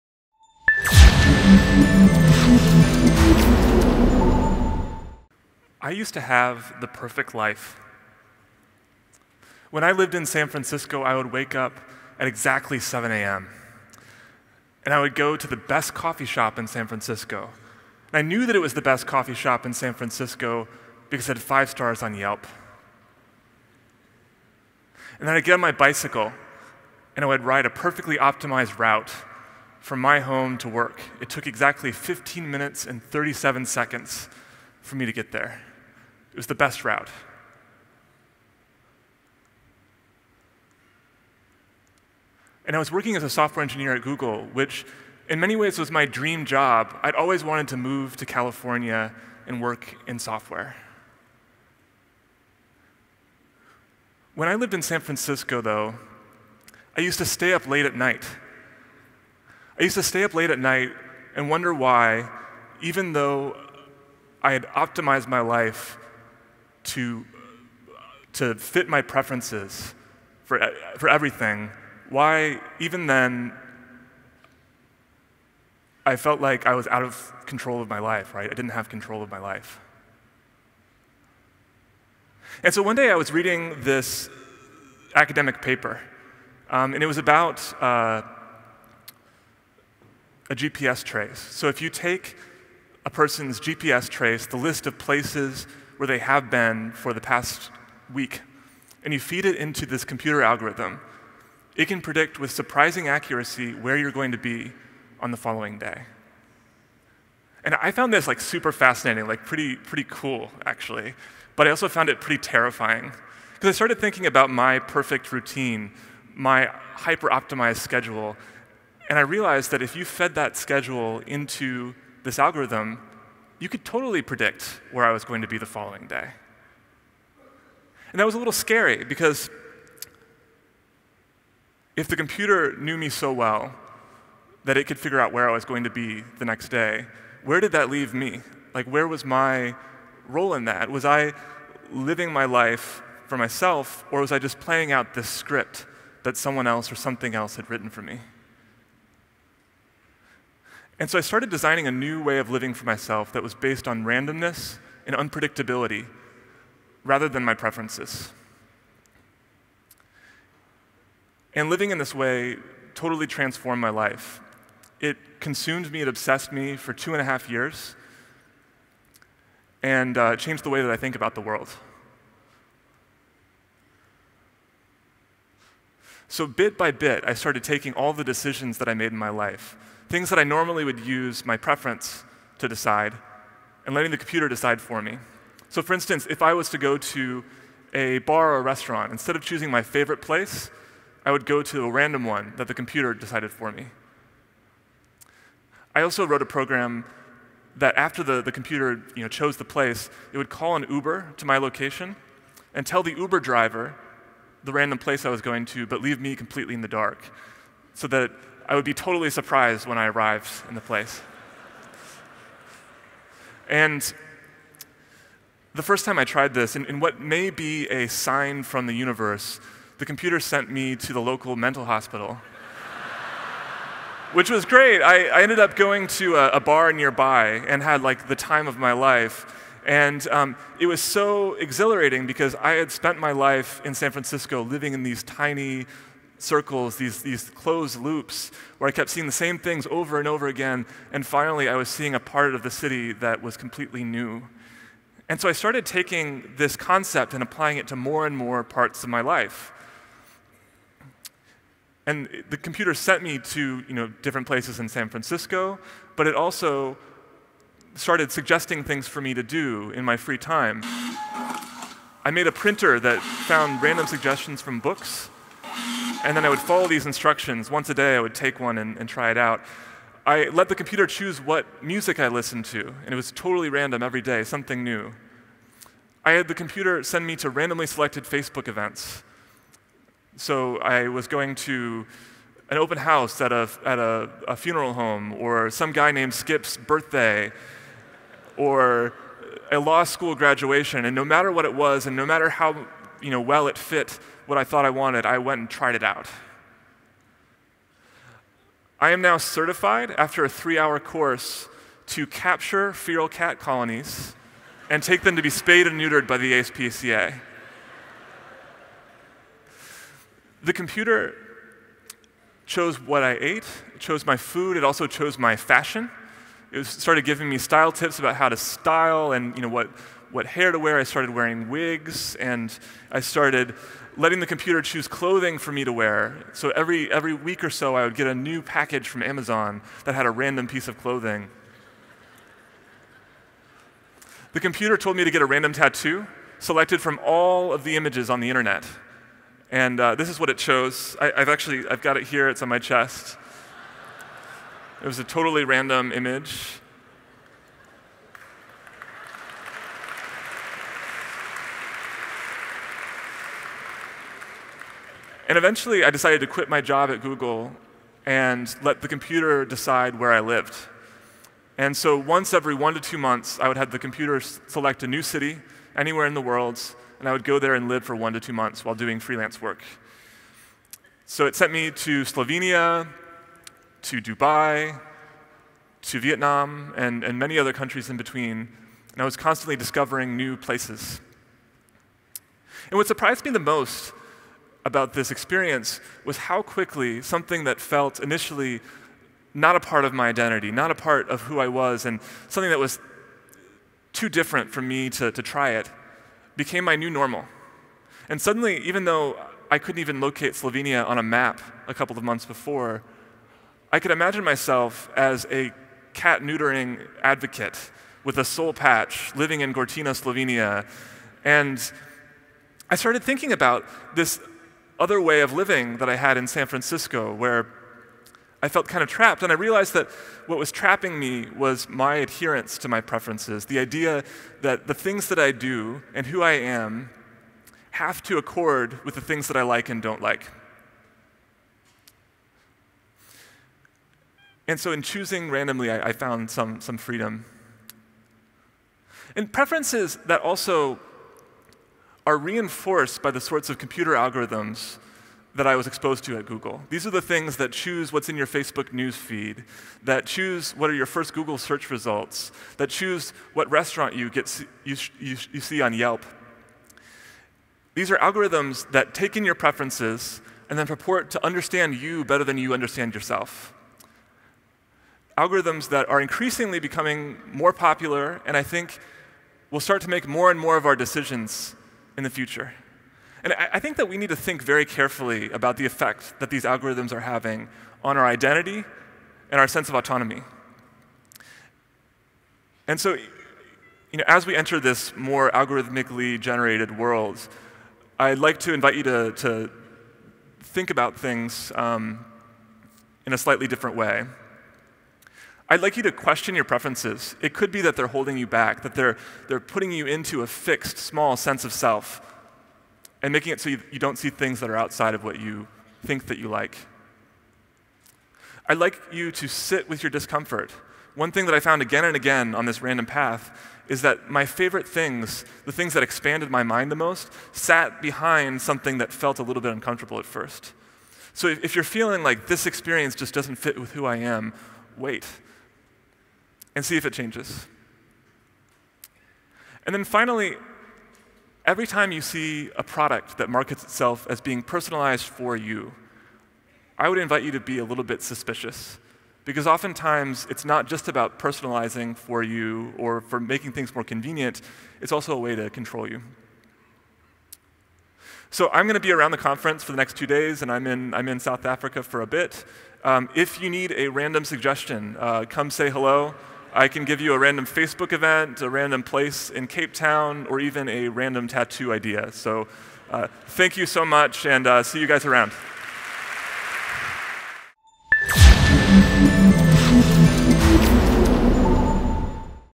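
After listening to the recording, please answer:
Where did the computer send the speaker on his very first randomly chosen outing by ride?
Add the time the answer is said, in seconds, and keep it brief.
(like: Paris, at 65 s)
Local mental hospital, at 221 s.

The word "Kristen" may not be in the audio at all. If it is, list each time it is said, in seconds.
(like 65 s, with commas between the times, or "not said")
not said.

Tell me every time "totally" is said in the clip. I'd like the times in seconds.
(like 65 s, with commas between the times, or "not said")
123 s, 162 s, 208 s, 273 s, 345 s.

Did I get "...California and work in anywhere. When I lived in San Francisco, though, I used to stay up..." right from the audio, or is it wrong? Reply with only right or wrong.
wrong.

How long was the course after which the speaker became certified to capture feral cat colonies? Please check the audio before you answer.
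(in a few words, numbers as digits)
3 hours.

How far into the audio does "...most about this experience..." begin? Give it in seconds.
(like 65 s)
383 s.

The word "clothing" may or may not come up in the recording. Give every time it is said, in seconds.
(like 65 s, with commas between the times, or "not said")
325 s, 330 s.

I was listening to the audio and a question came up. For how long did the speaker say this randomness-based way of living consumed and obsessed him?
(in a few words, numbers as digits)
Two and a half years.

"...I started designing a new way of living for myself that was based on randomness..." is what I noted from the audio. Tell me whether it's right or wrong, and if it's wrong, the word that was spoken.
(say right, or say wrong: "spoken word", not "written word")
right.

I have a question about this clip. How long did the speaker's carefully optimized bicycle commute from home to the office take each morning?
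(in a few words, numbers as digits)
15 minutes and 37 seconds.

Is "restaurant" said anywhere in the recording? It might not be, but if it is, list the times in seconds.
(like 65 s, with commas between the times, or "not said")
188 s, 453 s.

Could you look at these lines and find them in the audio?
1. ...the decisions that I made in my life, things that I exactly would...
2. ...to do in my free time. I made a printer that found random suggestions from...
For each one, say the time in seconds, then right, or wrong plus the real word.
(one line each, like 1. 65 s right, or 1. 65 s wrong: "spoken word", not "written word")
1. 178 s wrong: "normally", not "exactly"
2. 259 s right.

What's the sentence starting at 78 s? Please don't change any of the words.
I didn't have control of my life.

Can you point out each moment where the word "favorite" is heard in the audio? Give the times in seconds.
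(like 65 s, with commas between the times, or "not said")
189 s, 514 s.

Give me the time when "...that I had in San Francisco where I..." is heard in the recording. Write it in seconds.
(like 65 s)
415 s.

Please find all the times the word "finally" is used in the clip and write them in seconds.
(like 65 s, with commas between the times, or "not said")
241 s, 530 s.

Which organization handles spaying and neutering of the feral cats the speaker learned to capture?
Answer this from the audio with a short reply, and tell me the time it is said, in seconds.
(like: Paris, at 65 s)
ASPCA, at 306 s.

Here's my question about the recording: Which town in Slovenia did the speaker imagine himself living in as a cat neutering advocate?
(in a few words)
Gortina.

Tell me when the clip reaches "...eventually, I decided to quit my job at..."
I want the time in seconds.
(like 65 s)
355 s.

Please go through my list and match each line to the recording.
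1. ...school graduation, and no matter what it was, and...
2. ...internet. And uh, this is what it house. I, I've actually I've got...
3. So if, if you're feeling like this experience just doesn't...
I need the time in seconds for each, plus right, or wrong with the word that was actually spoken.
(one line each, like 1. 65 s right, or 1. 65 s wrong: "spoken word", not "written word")
1. 290 s right
2. 338 s wrong: "chose", not "house"
3. 521 s right.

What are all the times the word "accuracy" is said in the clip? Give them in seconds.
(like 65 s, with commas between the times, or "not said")
103 s.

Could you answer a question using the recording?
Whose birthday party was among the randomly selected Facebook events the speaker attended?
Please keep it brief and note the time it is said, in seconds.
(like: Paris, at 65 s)
Skip's, at 286 s.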